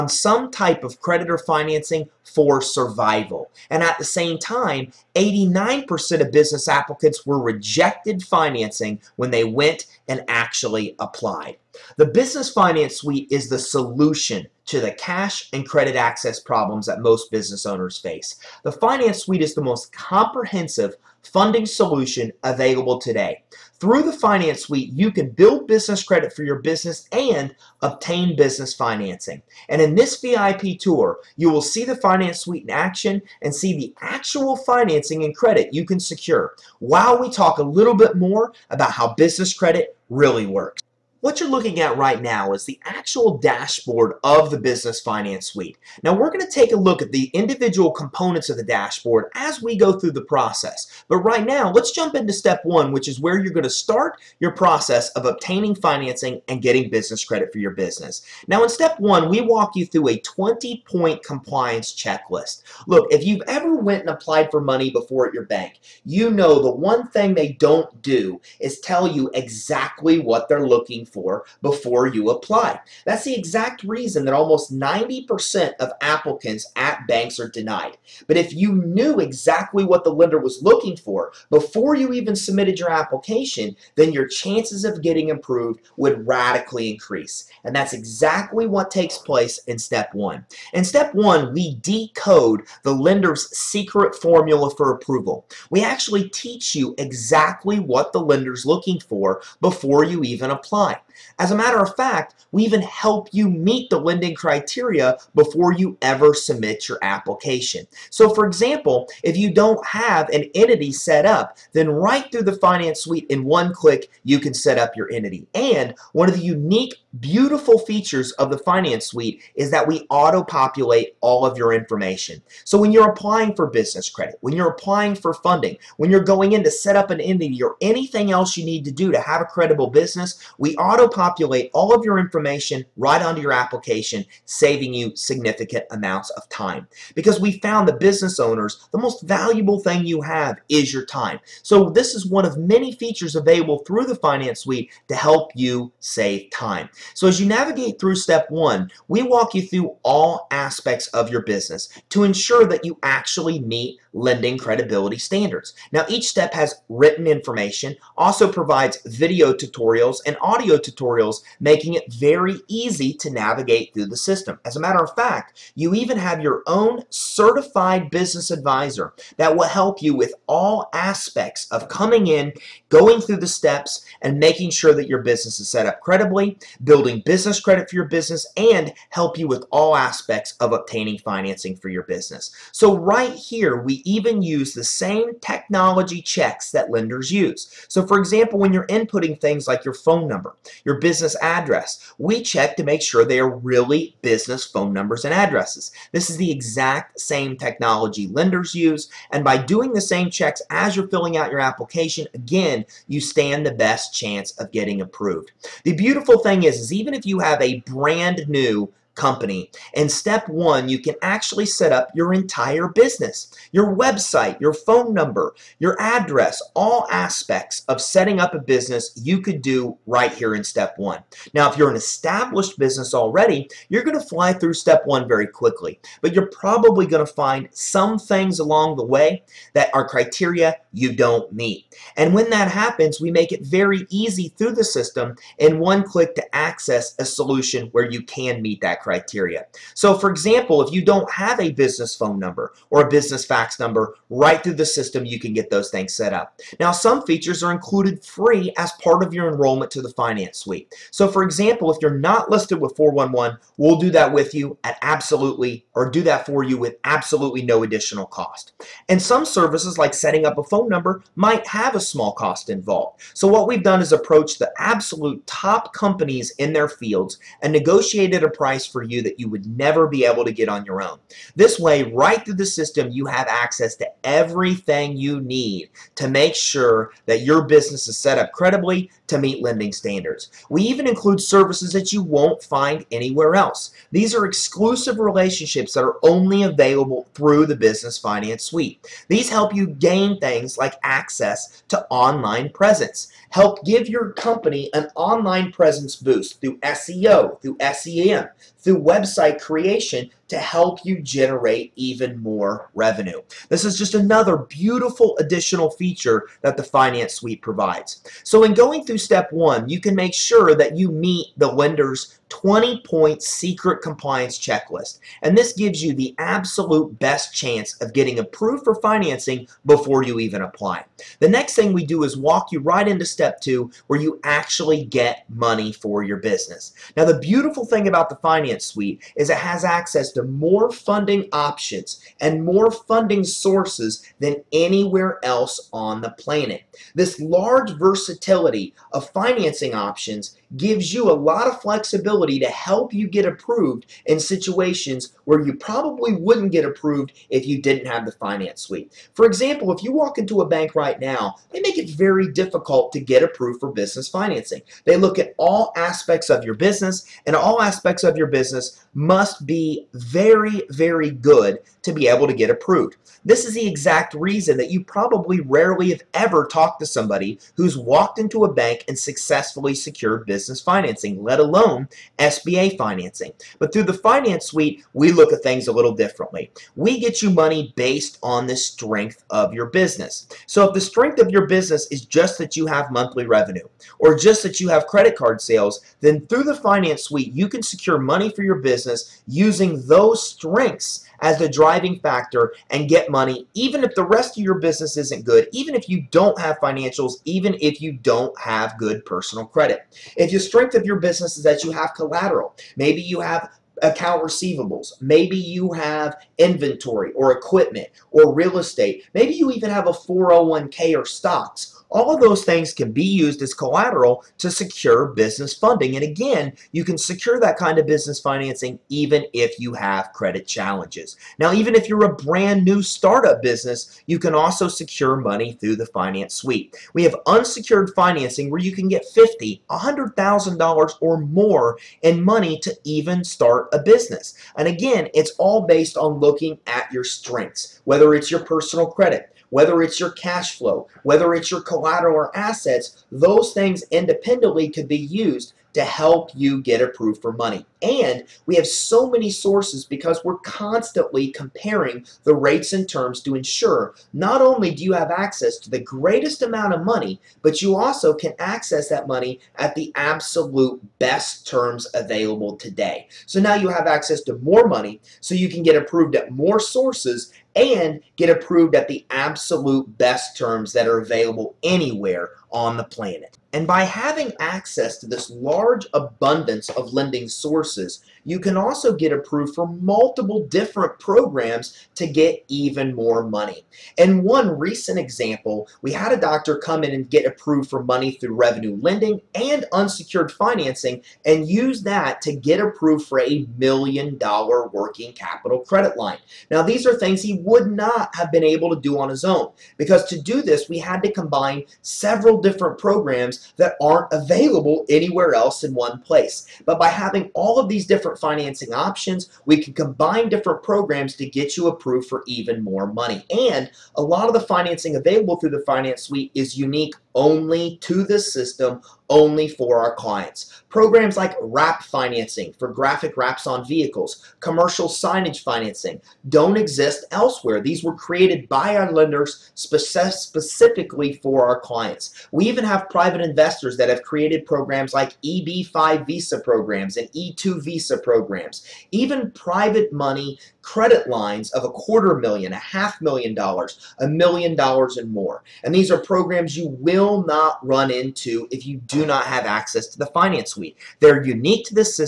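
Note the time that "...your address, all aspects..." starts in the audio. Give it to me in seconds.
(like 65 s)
215 s.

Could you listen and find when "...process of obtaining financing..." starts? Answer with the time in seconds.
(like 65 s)
54 s.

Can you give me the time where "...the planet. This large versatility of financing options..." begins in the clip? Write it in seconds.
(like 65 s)
336 s.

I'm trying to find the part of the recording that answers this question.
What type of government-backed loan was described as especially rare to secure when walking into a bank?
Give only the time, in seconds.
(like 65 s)
372 s.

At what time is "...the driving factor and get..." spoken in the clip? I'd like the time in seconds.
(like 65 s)
391 s.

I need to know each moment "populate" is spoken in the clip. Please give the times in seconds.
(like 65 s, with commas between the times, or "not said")
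120 s, 130 s.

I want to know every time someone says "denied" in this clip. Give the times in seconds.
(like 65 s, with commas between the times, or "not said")
77 s.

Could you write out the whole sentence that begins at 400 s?
If your strength of your business is that you have collateral, maybe you have account receivables.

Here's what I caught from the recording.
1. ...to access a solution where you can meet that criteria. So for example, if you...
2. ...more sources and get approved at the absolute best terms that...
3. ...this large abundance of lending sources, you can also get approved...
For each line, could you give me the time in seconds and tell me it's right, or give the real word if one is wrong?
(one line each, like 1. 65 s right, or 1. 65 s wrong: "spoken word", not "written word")
1. 236 s right
2. 466 s right
3. 475 s right.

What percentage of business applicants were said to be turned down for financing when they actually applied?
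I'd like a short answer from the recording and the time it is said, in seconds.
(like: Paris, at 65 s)
89%, at 5 s.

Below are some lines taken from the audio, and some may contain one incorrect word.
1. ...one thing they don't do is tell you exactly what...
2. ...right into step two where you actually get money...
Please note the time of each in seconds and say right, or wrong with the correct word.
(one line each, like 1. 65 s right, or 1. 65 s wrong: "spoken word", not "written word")
1. 66 s right
2. 322 s right.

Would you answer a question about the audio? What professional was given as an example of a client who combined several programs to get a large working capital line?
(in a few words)
doctor.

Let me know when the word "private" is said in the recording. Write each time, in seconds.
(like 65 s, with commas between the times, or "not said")
533 s, 539 s.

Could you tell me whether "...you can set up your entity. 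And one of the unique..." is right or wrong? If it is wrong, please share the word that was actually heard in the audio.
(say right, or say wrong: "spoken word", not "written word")
right.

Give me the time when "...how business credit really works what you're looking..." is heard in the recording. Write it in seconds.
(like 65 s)
38 s.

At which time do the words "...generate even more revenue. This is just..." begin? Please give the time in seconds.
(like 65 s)
301 s.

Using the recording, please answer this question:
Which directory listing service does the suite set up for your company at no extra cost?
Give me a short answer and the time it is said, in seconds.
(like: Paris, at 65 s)
411, at 252 s.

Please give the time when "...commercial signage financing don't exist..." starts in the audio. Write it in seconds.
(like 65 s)
524 s.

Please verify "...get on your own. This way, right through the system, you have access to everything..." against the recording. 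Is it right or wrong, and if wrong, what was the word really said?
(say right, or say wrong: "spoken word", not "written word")
right.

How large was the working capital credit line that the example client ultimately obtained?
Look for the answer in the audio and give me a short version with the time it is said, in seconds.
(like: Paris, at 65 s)
$1,000,000, at 493 s.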